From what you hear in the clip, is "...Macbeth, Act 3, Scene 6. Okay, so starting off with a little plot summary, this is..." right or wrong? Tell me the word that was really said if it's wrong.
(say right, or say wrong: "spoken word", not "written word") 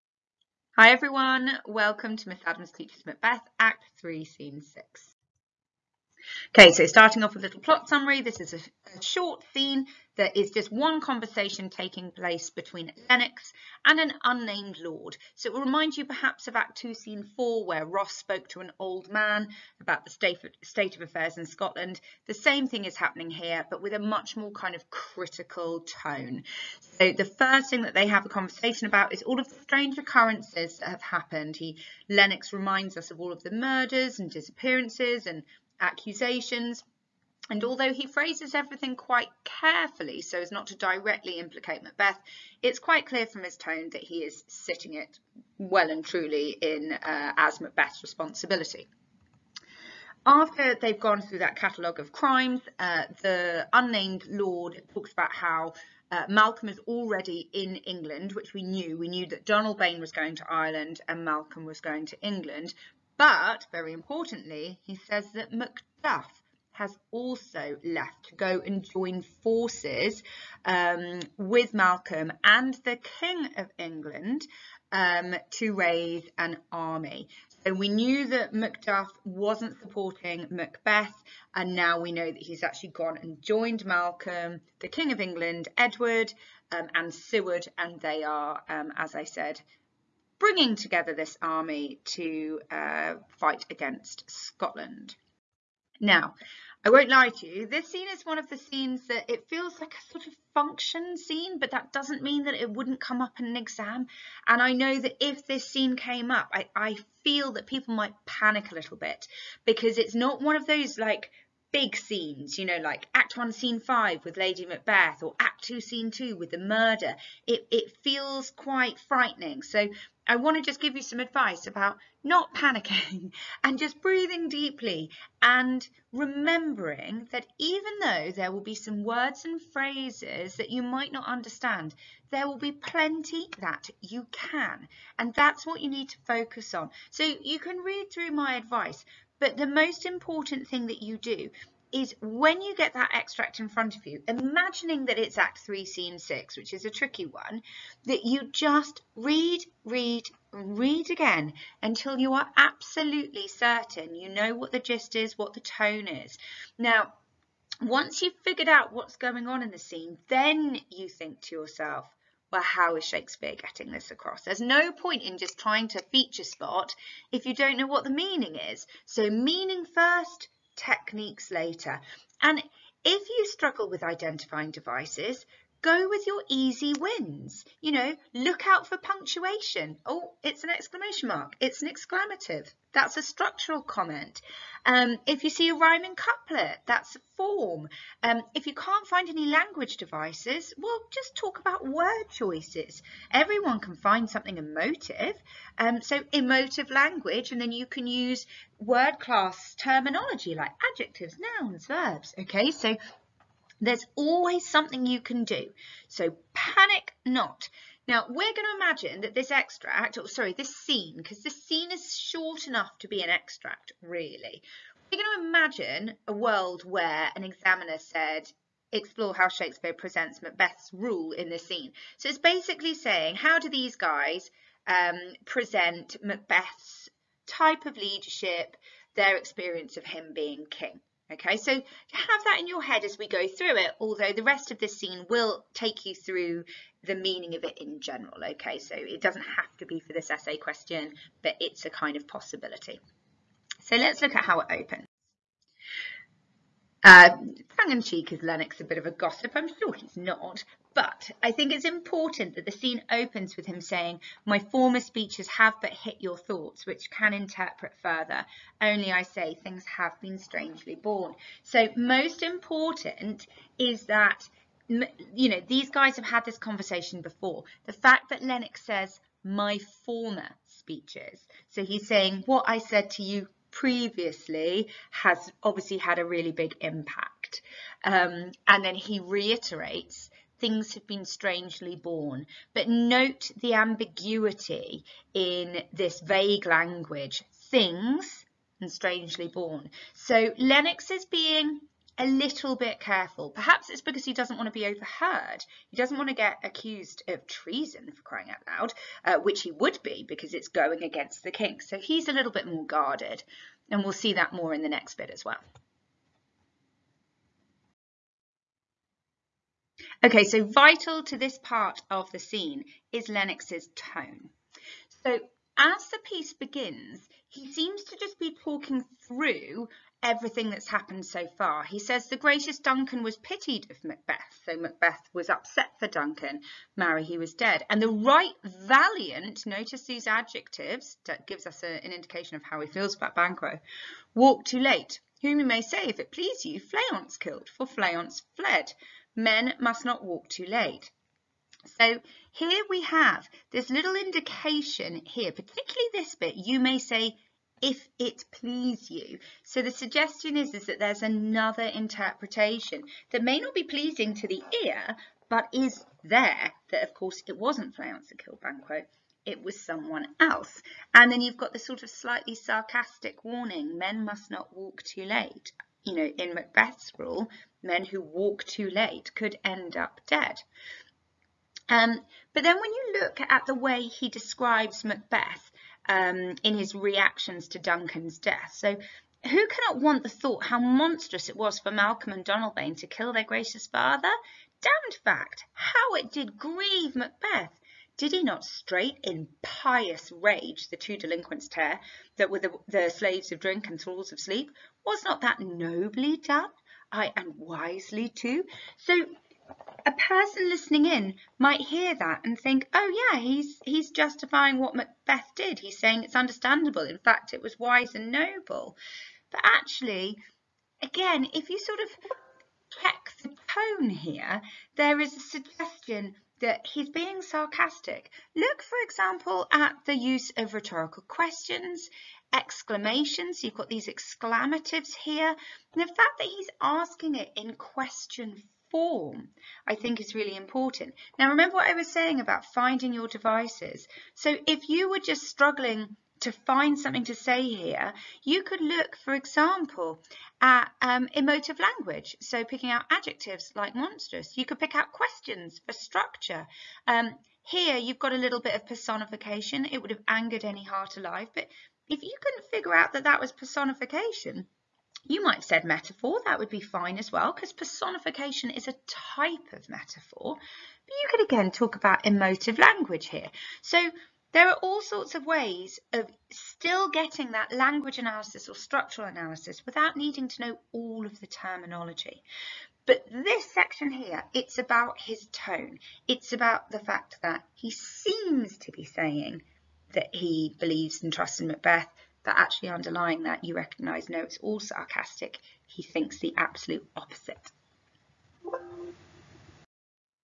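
right.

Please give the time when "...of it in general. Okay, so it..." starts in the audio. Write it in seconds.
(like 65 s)
237 s.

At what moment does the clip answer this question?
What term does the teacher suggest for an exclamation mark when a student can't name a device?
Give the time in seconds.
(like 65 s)
181 s.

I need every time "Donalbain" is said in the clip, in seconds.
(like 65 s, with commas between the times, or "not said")
59 s, 382 s.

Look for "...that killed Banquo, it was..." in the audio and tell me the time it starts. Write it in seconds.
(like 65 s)
358 s.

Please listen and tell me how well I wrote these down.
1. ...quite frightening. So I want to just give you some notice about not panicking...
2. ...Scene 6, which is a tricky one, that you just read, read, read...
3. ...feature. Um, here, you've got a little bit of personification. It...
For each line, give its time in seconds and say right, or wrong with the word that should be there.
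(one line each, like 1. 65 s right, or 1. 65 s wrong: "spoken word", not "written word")
1. 118 s wrong: "advice", not "notice"
2. 145 s right
3. 445 s wrong: "structure", not "feature".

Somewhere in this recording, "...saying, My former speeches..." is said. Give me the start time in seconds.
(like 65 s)
253 s.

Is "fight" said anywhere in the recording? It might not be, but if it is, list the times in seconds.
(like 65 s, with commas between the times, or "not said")
93 s.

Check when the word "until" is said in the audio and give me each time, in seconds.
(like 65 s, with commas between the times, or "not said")
151 s.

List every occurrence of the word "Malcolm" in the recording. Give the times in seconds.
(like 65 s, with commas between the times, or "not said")
56 s, 61 s, 71 s, 83 s, 381 s.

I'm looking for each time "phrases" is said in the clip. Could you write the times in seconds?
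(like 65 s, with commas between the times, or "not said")
38 s, 129 s.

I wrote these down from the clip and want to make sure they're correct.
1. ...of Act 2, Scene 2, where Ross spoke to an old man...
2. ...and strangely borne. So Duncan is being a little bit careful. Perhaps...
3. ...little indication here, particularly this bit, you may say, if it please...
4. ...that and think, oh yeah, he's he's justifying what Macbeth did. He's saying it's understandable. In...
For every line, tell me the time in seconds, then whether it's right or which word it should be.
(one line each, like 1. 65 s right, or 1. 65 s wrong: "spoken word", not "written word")
1. 16 s wrong: "4", not "2"
2. 288 s wrong: "Lennox", not "Duncan"
3. 343 s right
4. 402 s right.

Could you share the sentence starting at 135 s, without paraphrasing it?
And that's what you need to focus on.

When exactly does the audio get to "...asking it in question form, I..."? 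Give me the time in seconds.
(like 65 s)
426 s.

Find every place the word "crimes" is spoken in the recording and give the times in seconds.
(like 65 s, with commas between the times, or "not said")
52 s.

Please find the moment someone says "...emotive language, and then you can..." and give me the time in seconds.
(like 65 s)
196 s.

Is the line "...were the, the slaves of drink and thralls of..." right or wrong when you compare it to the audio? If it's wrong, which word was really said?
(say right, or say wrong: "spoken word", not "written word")
right.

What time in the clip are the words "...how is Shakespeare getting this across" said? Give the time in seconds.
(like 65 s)
162 s.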